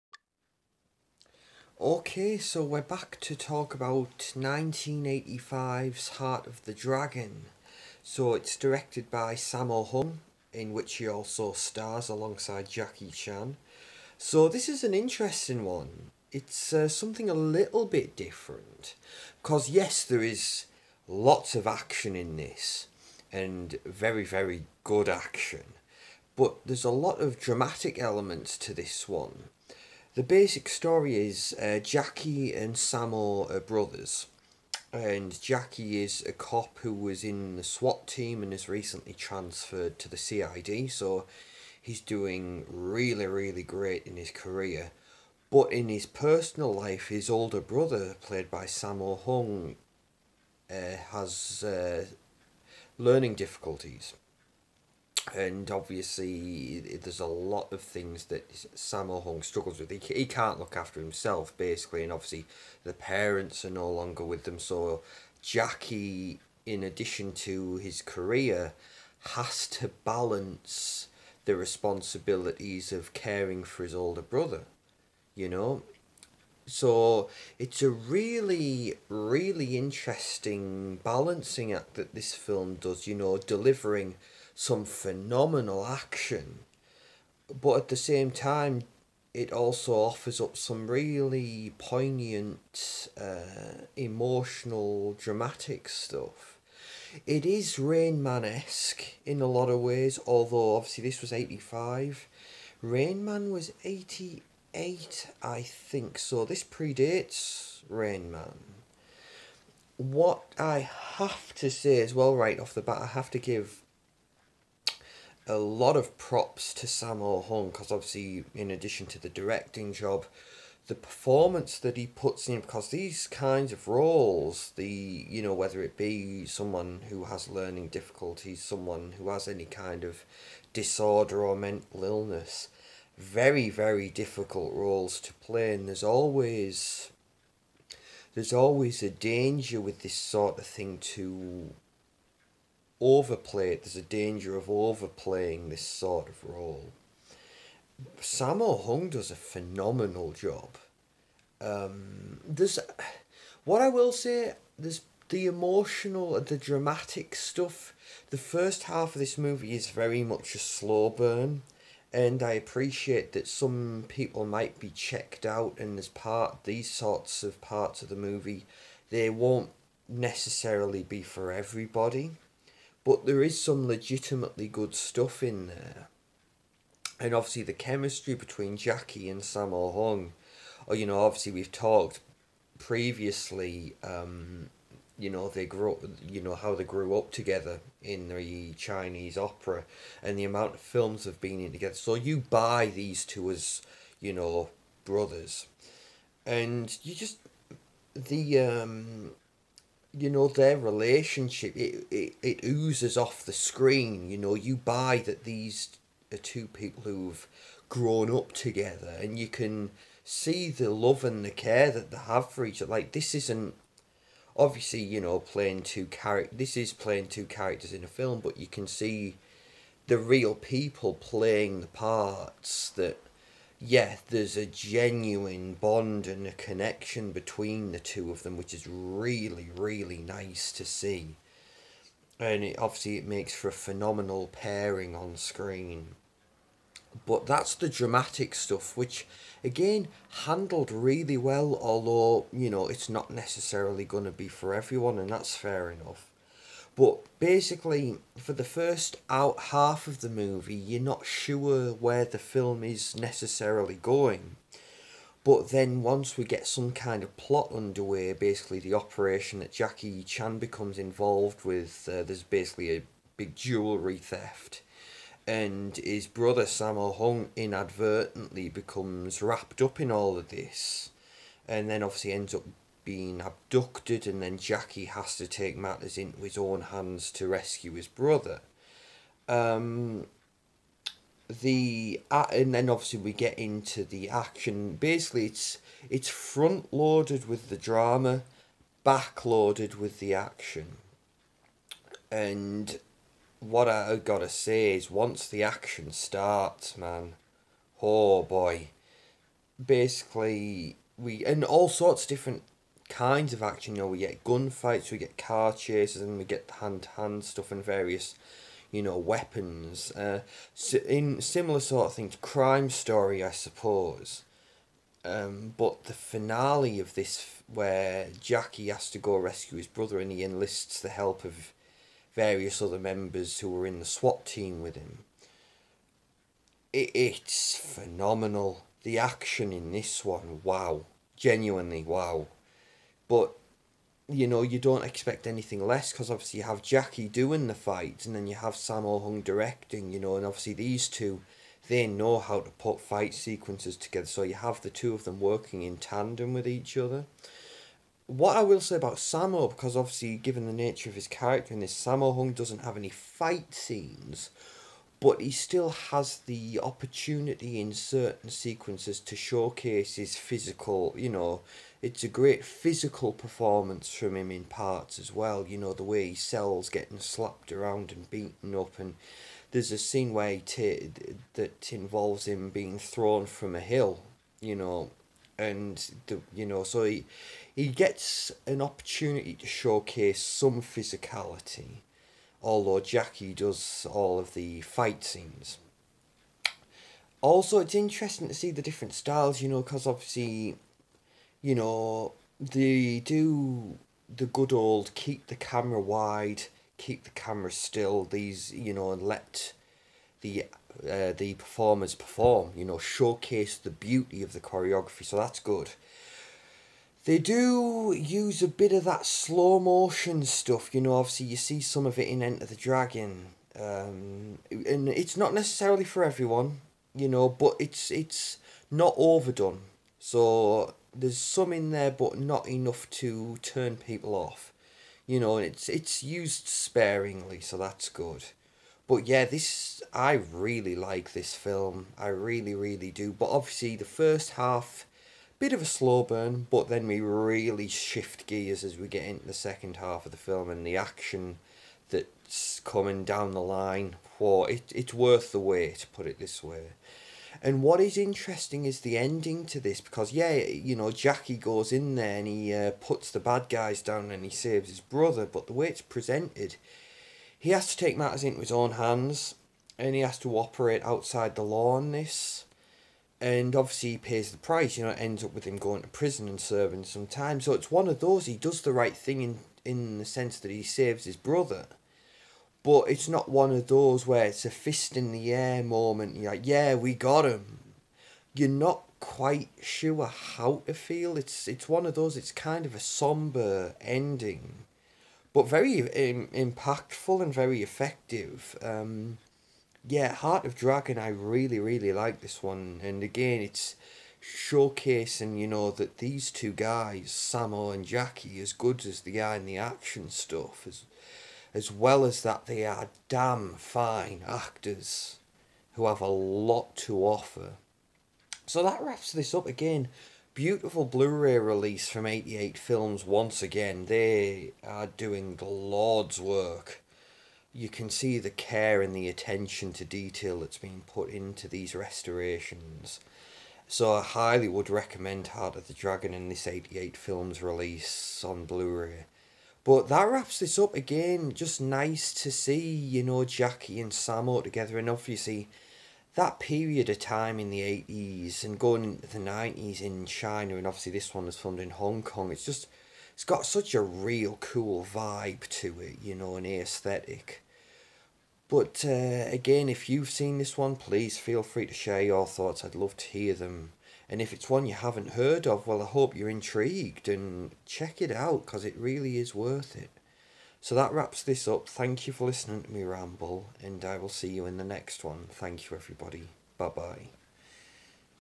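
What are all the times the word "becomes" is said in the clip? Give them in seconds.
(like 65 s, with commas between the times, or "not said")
260 s, 268 s.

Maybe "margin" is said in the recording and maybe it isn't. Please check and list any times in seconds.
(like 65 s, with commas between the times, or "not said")
not said.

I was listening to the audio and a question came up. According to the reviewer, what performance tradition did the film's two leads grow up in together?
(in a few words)
Chinese opera.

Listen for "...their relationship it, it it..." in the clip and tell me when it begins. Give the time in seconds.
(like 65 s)
200 s.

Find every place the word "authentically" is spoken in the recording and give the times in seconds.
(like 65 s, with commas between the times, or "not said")
not said.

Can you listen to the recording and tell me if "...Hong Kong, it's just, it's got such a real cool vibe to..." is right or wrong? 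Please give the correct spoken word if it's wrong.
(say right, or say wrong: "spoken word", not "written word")
right.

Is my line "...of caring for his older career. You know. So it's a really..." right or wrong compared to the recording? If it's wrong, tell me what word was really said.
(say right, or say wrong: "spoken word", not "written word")
wrong: "brother", not "career".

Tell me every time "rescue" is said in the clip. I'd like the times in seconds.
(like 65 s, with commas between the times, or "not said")
277 s, 319 s.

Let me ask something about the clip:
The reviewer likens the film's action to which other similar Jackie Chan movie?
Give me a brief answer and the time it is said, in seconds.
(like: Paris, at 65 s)
Crime Story, at 312 s.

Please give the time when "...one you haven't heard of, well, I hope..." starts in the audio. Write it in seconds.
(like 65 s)
554 s.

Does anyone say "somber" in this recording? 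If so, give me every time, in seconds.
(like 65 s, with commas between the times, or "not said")
482 s.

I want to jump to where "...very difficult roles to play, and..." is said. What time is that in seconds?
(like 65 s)
133 s.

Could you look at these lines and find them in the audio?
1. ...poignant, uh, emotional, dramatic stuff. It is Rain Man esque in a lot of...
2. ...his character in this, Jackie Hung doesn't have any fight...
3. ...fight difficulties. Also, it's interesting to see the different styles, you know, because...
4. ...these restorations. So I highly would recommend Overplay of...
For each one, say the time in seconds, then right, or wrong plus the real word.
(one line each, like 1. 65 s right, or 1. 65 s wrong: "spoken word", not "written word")
1. 91 s right
2. 351 s wrong: "Sammo", not "Jackie"
3. 384 s wrong: "scenes", not "difficulties"
4. 521 s wrong: "Heart", not "Overplay".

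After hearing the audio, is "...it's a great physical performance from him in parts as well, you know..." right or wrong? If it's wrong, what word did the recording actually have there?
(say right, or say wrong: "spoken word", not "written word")
right.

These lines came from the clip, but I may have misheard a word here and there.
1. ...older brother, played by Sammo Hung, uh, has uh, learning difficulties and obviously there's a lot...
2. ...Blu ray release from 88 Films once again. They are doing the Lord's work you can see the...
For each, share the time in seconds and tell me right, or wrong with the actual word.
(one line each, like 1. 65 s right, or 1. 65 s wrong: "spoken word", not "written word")
1. 47 s right
2. 511 s right.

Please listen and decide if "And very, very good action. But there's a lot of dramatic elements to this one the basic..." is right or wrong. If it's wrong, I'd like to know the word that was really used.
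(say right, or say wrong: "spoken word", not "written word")
right.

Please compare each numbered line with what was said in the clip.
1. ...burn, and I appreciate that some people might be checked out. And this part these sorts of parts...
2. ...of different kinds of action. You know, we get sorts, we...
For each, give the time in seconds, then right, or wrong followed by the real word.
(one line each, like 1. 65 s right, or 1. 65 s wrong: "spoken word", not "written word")
1. 161 s right
2. 302 s wrong: "gunfights", not "sorts".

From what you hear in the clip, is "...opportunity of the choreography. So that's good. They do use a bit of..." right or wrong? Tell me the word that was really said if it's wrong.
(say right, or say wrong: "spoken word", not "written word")
wrong: "beauty", not "opportunity".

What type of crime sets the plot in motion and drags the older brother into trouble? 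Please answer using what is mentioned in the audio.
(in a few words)
Jewellery theft.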